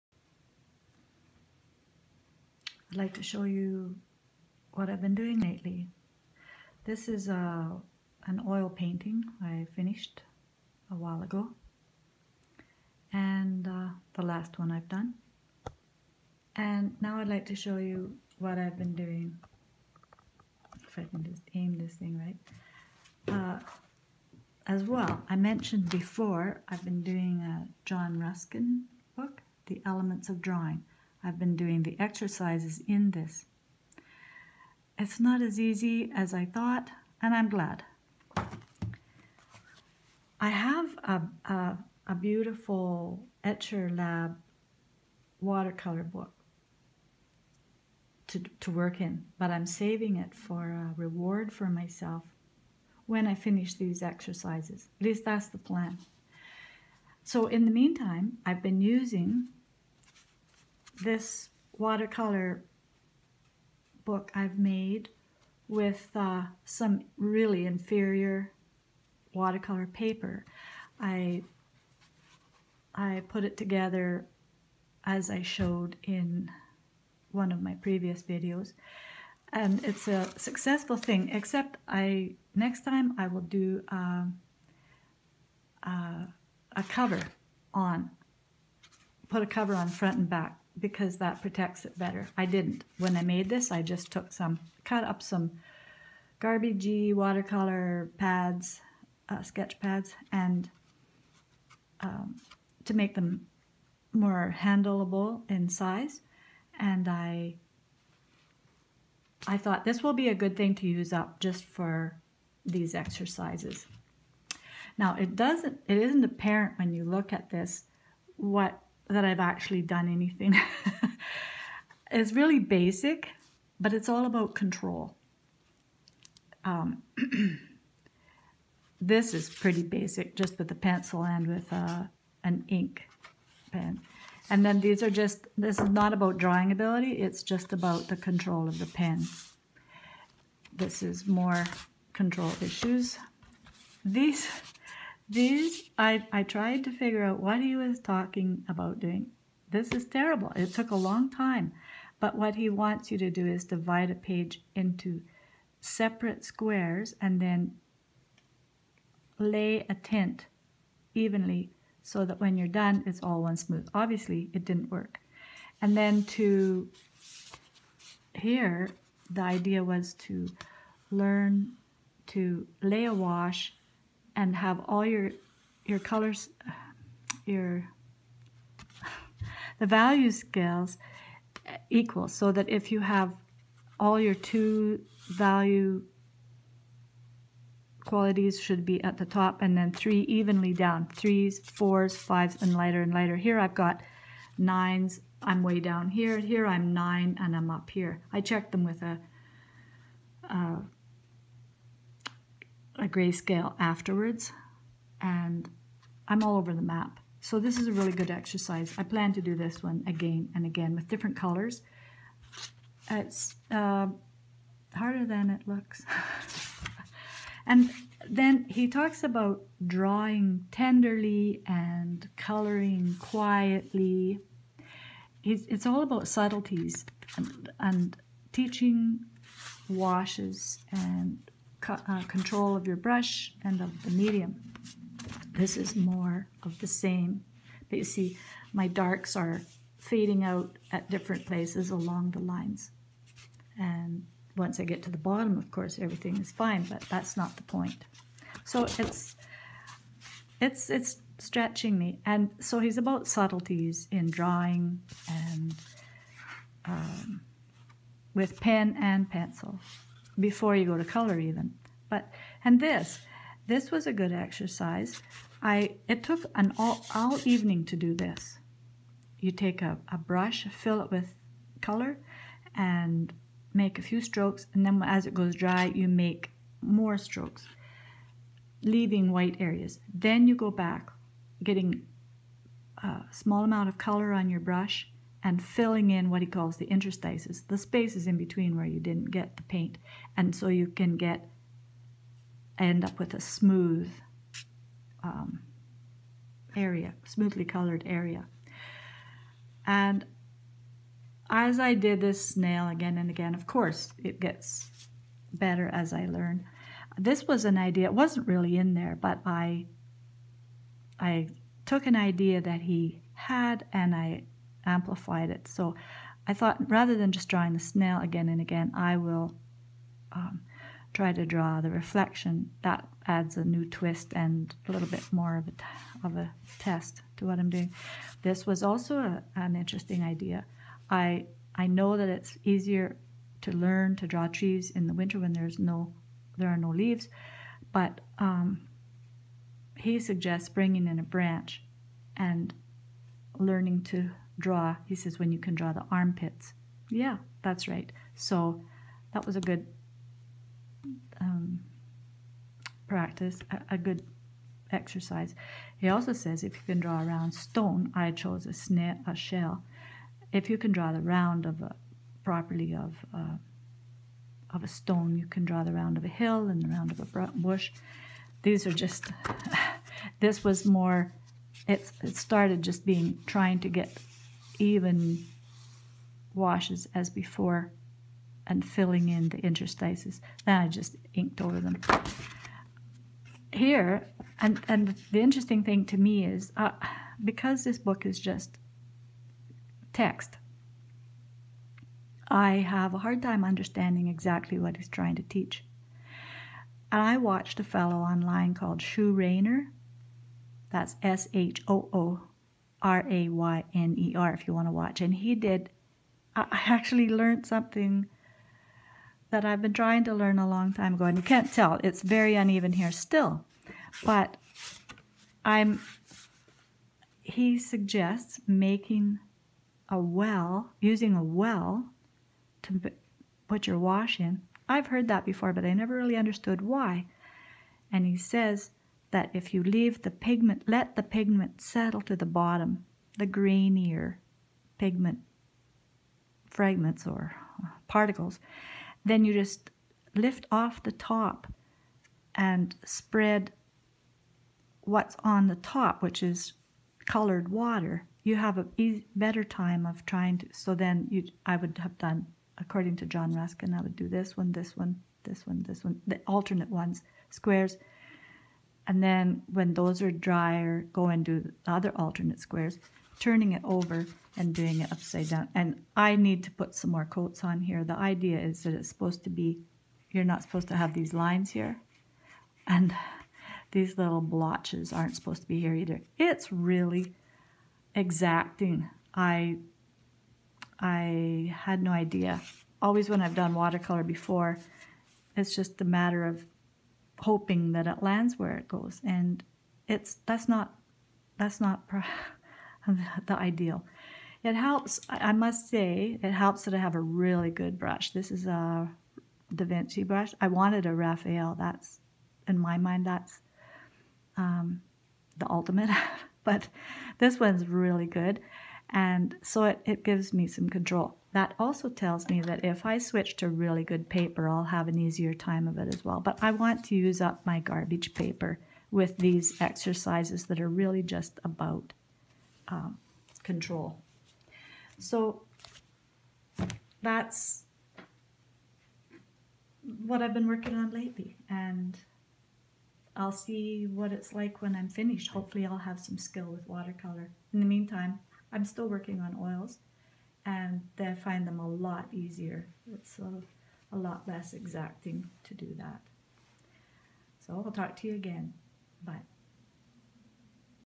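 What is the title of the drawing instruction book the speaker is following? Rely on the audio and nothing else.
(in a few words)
The Elements of Drawing.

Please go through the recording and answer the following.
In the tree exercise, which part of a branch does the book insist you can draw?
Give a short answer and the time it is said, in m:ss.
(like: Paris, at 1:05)
armpits, at 5:46.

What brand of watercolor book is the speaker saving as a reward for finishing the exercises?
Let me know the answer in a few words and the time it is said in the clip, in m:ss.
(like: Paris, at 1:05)
Etchr Lab, at 0:43.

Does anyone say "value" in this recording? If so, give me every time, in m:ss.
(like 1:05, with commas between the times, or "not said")
2:59, 3:05.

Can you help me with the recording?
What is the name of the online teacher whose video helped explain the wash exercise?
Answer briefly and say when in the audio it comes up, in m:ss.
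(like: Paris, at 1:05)
Shoo Rayner, at 6:39.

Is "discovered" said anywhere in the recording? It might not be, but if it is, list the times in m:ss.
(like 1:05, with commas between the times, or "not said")
not said.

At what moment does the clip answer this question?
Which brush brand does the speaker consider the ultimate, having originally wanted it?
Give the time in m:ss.
8:21.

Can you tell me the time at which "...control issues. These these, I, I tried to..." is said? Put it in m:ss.
2:22.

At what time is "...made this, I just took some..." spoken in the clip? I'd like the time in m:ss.
1:33.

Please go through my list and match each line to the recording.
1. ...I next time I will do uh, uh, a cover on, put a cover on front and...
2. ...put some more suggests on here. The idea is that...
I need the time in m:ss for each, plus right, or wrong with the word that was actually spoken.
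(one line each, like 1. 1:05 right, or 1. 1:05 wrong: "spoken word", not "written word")
1. 1:21 right
2. 7:46 wrong: "coats", not "suggests".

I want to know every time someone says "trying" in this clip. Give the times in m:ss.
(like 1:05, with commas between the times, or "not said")
6:13, 6:35, 6:49, 7:30.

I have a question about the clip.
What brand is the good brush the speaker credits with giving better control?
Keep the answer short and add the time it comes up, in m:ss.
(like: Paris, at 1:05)
Da Vinci, at 8:19.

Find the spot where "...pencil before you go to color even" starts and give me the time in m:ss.
4:19.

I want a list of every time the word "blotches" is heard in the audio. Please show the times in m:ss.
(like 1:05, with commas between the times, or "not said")
7:54.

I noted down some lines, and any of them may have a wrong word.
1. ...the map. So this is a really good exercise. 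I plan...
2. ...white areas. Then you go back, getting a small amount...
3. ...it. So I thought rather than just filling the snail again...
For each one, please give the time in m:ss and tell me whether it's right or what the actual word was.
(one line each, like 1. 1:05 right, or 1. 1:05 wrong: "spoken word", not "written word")
1. 3:26 right
2. 4:39 right
3. 5:15 wrong: "drawing", not "filling".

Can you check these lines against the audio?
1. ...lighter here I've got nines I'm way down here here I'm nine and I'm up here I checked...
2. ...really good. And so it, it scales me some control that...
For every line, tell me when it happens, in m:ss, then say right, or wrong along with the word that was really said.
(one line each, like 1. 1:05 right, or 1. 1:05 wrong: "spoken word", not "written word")
1. 3:13 right
2. 8:27 wrong: "gives", not "scales".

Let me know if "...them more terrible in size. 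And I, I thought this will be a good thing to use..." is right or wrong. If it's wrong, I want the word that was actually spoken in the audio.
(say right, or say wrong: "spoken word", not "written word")
wrong: "handleable", not "terrible".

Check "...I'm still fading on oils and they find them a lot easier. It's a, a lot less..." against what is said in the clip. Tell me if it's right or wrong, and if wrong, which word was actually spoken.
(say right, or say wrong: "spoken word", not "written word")
wrong: "working", not "fading".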